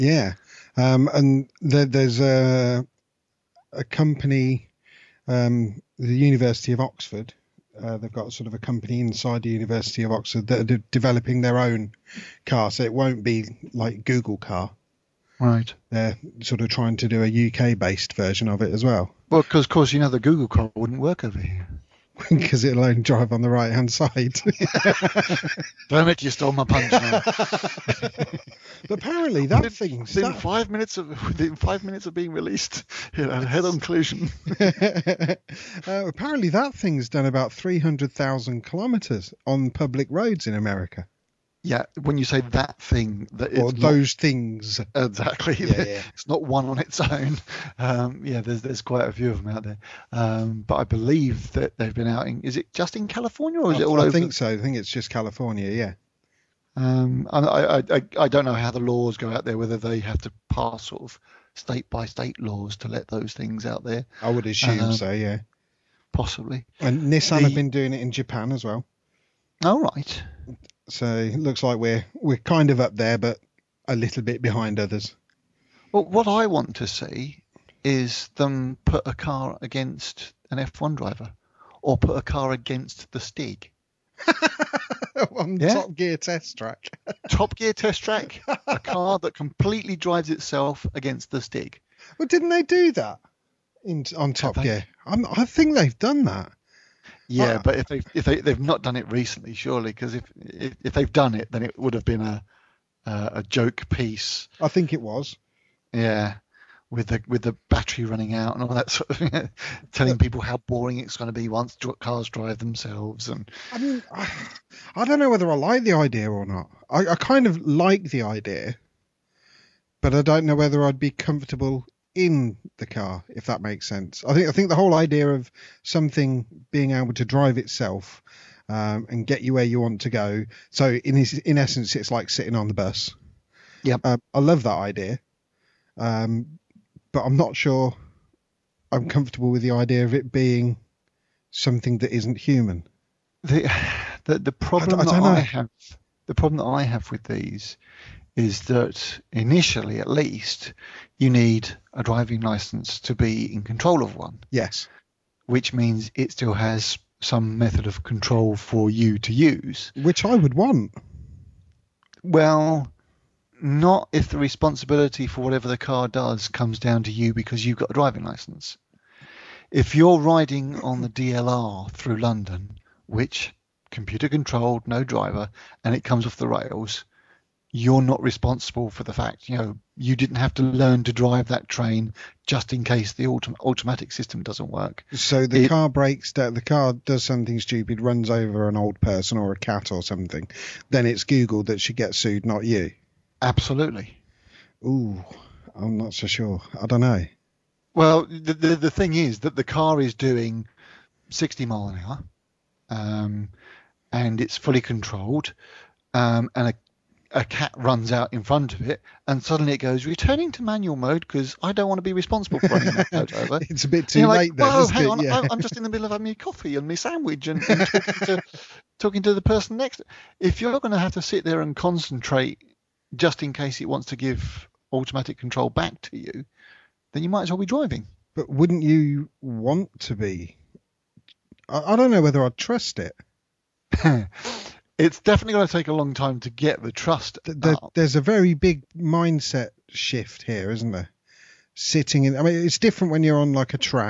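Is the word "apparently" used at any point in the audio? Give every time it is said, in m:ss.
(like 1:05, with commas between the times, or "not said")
0:28, 0:36.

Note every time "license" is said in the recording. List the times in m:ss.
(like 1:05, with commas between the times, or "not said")
2:32, 2:48.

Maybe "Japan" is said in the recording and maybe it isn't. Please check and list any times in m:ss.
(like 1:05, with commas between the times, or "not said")
1:08.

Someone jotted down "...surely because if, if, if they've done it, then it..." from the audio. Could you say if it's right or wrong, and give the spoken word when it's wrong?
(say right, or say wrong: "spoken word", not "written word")
right.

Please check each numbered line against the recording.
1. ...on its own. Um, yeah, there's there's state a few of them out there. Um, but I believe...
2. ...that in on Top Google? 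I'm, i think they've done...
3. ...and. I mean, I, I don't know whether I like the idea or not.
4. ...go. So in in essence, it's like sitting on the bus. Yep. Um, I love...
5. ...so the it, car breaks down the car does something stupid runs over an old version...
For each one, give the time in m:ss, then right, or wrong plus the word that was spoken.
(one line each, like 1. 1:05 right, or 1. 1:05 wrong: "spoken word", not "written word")
1. 0:46 wrong: "quite", not "state"
2. 1:32 wrong: "Gear", not "Google"
3. 1:53 right
4. 2:10 right
5. 3:05 wrong: "person", not "version".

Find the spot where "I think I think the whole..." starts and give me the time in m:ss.
2:04.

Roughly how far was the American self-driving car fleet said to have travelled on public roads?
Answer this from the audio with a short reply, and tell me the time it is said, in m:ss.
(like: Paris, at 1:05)
300,000 kilometers, at 0:37.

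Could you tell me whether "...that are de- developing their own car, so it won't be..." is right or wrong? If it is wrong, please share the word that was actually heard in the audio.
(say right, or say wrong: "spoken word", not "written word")
right.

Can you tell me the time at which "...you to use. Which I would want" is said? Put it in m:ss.
2:38.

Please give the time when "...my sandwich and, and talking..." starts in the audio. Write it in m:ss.
3:36.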